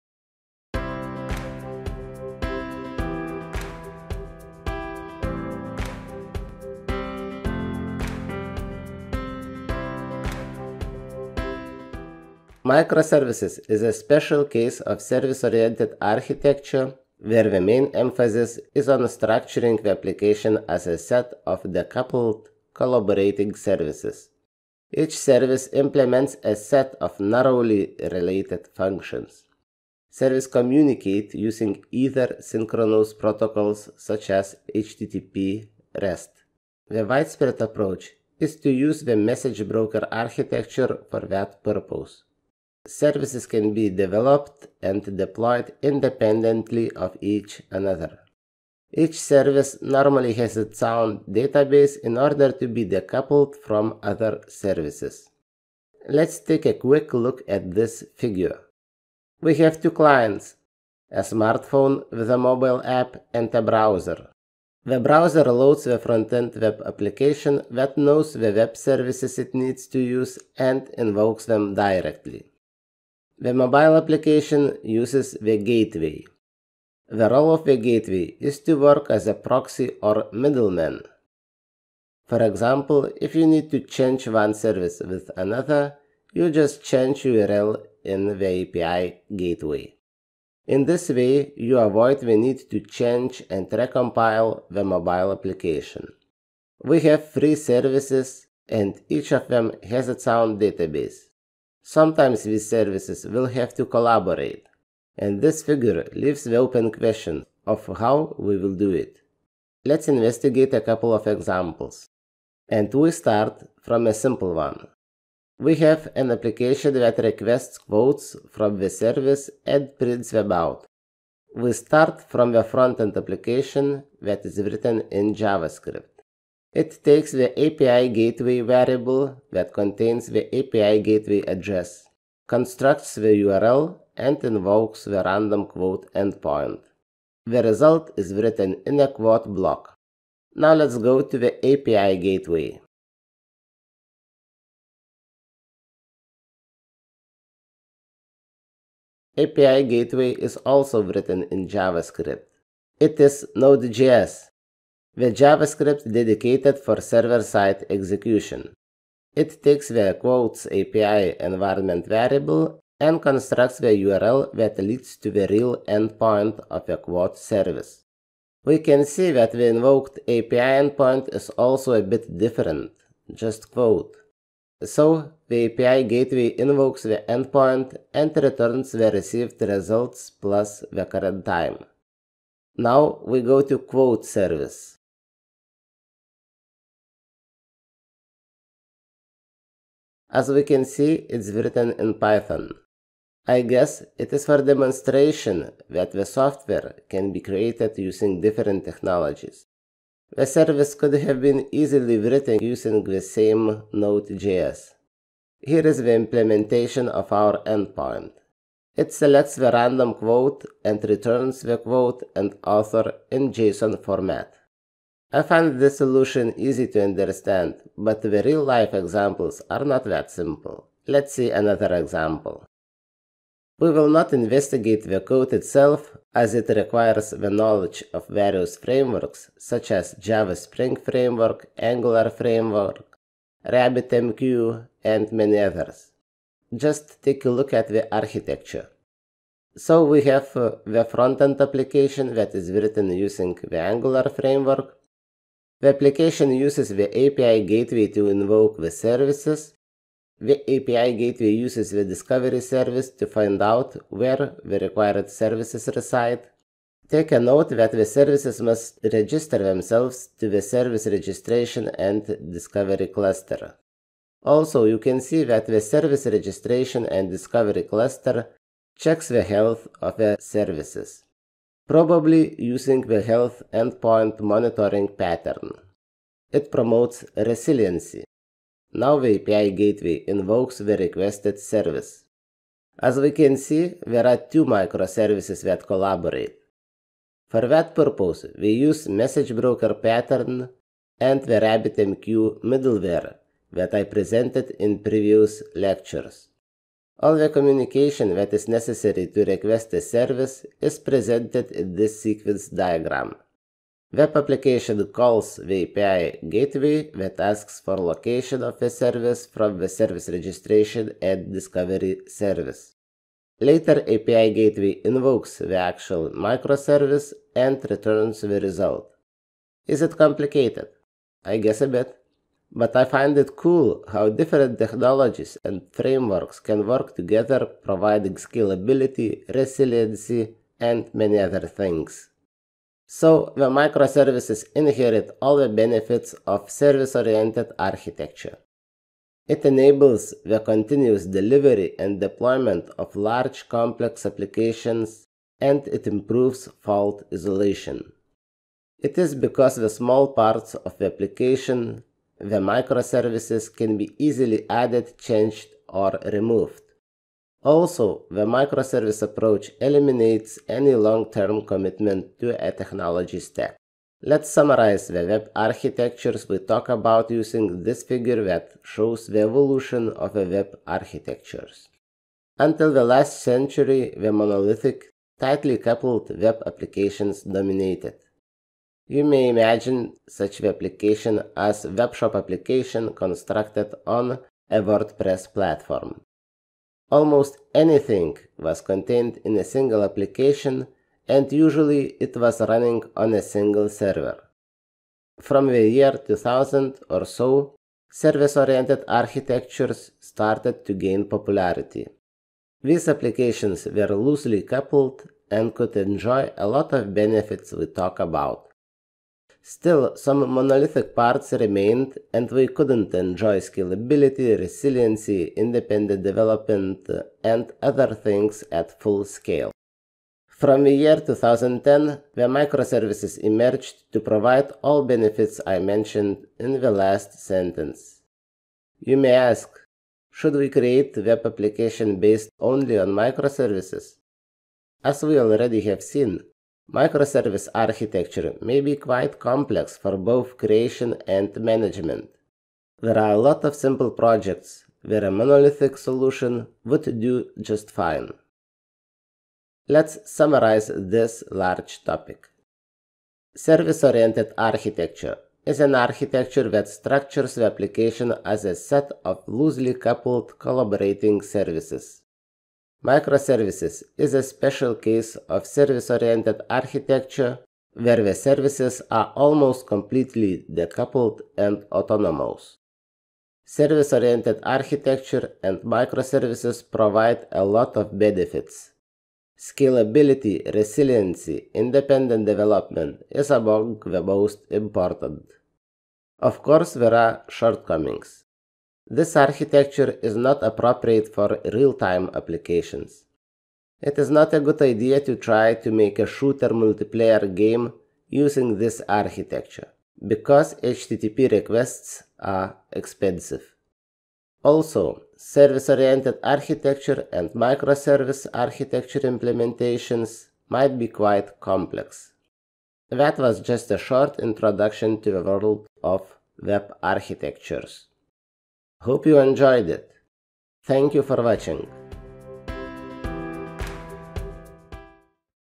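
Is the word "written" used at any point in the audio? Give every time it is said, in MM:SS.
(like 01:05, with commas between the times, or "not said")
02:04, 02:18, 02:31, 03:11, 03:22, 04:02.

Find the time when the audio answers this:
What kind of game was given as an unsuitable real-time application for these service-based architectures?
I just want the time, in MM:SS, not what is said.
08:16.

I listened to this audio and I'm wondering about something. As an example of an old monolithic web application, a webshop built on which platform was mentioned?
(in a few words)
WordPress.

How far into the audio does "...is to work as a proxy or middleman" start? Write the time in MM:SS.
01:18.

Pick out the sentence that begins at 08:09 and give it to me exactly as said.
This architecture is not appropriate for real-time applications.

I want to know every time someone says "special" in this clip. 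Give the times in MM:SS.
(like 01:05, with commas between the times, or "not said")
00:13, 07:44.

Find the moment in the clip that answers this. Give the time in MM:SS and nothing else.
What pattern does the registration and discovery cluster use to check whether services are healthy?
04:33.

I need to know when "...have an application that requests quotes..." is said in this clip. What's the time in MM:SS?
01:55.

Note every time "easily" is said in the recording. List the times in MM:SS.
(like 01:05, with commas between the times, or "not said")
03:21, 05:54.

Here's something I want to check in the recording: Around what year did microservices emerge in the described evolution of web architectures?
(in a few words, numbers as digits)
2010.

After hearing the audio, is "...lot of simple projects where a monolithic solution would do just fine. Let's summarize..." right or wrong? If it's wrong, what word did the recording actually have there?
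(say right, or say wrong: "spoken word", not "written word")
right.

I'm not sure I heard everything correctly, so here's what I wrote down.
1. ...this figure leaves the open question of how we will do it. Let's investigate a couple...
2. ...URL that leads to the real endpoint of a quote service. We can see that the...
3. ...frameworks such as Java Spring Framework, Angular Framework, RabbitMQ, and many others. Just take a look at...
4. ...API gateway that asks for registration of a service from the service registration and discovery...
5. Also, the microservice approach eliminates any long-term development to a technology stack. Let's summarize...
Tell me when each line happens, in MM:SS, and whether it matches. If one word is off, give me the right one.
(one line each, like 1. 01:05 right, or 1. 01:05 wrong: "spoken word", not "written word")
1. 01:45 right
2. 02:43 right
3. 03:48 right
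4. 05:05 wrong: "location", not "registration"
5. 05:57 wrong: "commitment", not "development".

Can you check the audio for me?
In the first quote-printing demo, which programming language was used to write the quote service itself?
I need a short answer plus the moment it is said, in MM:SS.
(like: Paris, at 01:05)
Python, at 03:11.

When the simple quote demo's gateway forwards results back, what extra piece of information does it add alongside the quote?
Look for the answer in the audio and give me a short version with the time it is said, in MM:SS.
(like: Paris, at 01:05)
the current time, at 03:00.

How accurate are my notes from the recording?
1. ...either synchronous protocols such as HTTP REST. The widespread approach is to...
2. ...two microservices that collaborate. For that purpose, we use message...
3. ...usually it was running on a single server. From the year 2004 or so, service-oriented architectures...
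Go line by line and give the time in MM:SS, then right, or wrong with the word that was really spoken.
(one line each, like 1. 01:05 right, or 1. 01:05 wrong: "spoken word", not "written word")
1. 00:31 right
2. 04:44 right
3. 06:31 wrong: "2000", not "2004".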